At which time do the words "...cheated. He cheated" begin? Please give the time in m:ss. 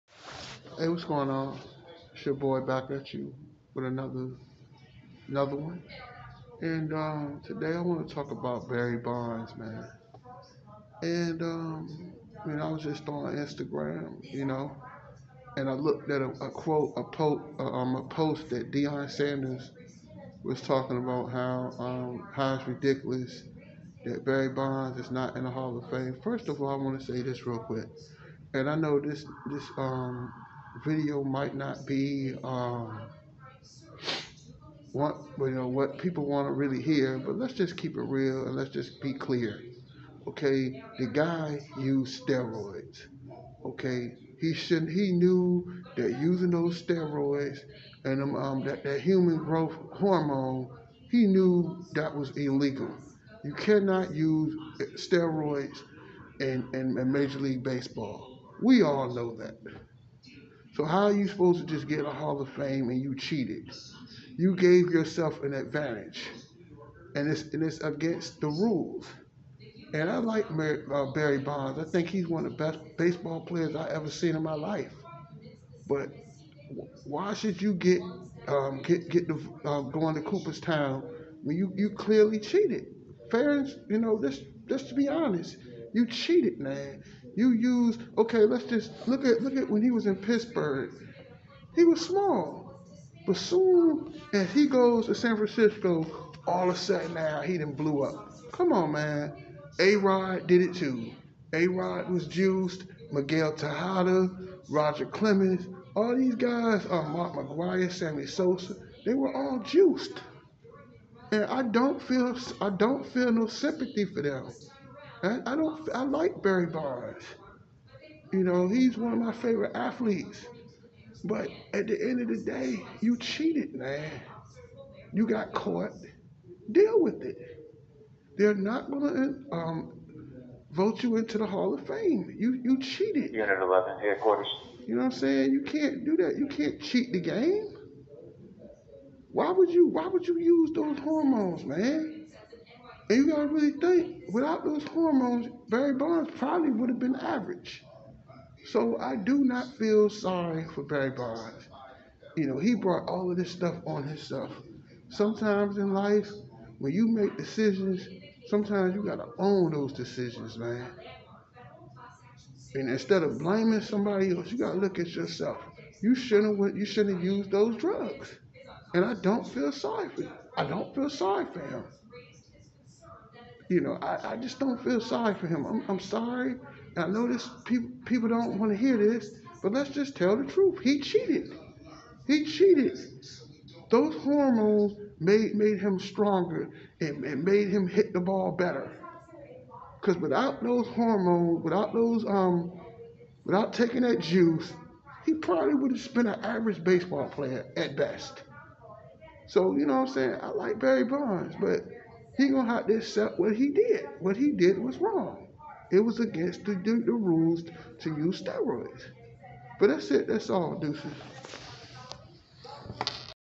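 3:00.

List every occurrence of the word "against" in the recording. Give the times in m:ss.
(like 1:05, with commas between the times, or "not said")
1:07, 3:26.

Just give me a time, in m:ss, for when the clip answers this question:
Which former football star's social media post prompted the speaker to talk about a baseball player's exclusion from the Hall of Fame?
0:18.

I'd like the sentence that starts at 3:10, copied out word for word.
Because without those hormones, without those um, without taking that juice, he probably would have been an average baseball player at best.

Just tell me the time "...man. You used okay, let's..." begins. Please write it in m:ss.
1:26.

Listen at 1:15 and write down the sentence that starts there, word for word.
But why should you get um, get get the, uh, going to Cooperstown when you, you clearly cheated?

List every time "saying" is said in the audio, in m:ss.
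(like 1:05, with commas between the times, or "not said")
2:15, 3:20.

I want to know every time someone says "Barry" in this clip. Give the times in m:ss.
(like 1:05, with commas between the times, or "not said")
0:08, 0:24, 1:11, 1:56, 2:25, 2:30, 3:20.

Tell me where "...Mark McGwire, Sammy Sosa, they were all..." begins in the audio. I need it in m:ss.
1:47.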